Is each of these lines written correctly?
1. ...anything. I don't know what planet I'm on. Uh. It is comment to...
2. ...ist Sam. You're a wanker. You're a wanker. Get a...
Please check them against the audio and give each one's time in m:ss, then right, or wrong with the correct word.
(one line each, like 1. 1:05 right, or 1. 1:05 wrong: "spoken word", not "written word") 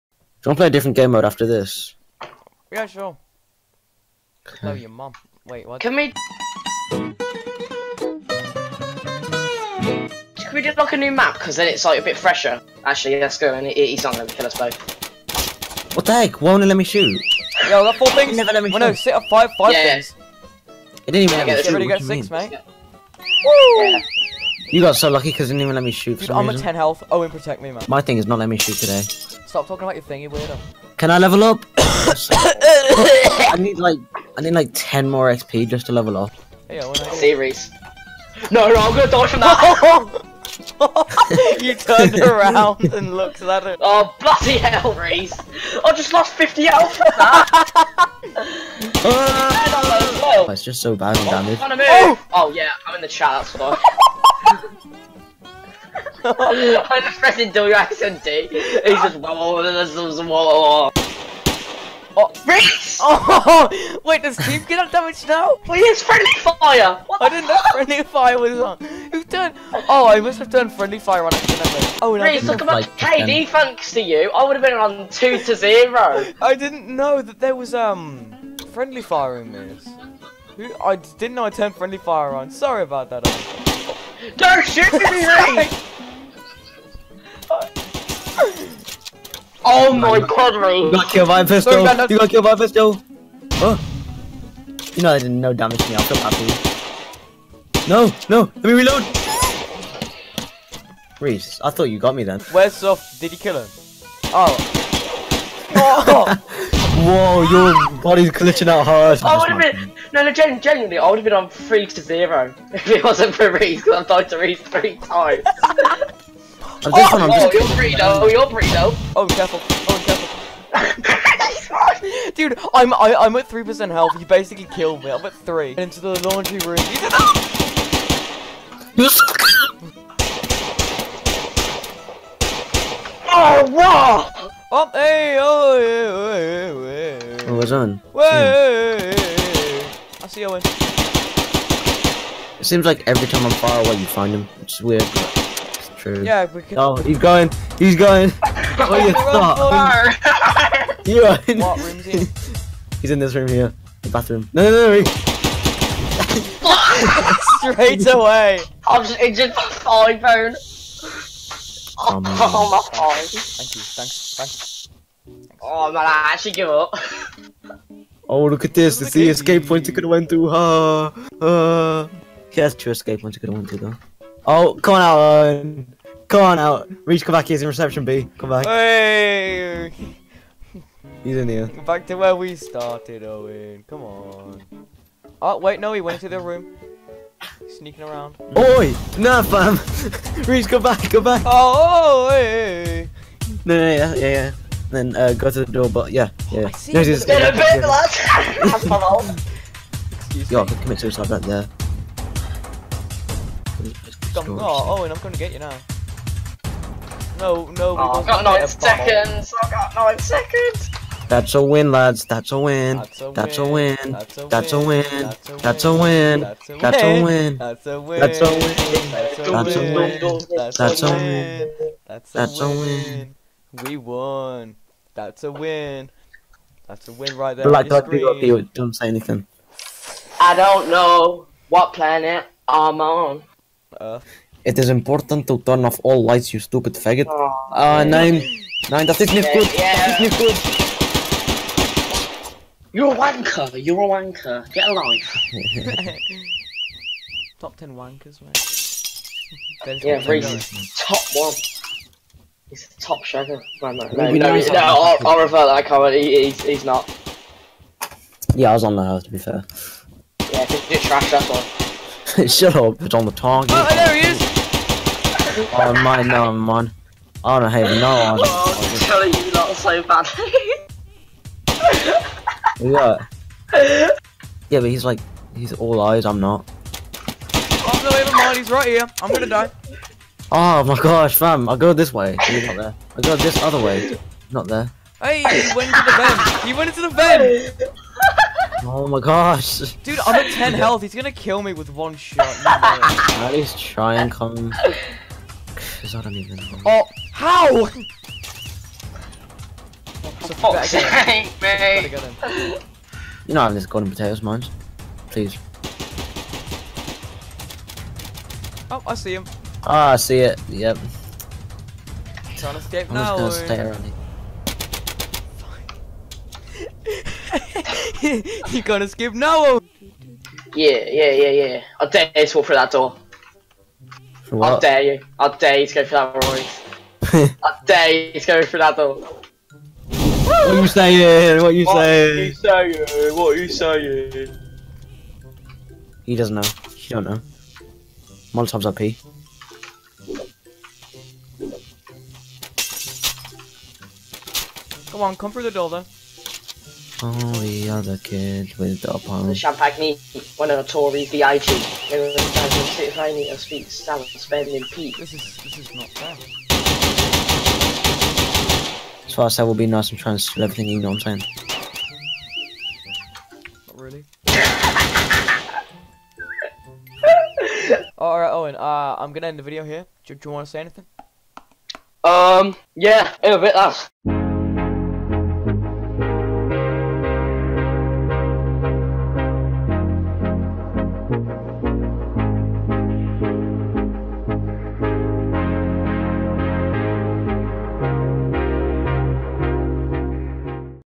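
1. 3:49 wrong: "important", not "comment"
2. 3:59 wrong: "Yeah", not "Sam".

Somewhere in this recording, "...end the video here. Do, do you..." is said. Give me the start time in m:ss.
6:09.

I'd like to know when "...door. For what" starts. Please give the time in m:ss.
5:22.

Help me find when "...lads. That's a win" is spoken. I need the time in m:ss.
3:31.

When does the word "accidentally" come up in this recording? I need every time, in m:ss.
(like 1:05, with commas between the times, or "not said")
0:57, 1:11.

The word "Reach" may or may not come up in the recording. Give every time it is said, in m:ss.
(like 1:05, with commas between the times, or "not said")
2:57, 3:10.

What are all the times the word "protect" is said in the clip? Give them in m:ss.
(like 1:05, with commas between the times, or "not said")
0:27.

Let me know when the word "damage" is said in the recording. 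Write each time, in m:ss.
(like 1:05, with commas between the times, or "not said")
0:51, 1:04, 1:35.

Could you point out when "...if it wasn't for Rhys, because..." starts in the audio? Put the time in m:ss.
1:52.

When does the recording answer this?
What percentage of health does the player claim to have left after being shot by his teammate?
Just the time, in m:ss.
2:03.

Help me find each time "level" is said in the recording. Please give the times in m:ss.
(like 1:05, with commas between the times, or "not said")
0:31, 0:35.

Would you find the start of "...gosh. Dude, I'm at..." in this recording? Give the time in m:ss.
4:49.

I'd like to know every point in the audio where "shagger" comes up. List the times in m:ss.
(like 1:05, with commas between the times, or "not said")
4:13.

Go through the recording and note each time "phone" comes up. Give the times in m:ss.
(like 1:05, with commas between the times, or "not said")
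2:40.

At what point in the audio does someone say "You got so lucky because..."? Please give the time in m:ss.
0:24.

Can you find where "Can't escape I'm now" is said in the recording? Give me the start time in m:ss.
5:12.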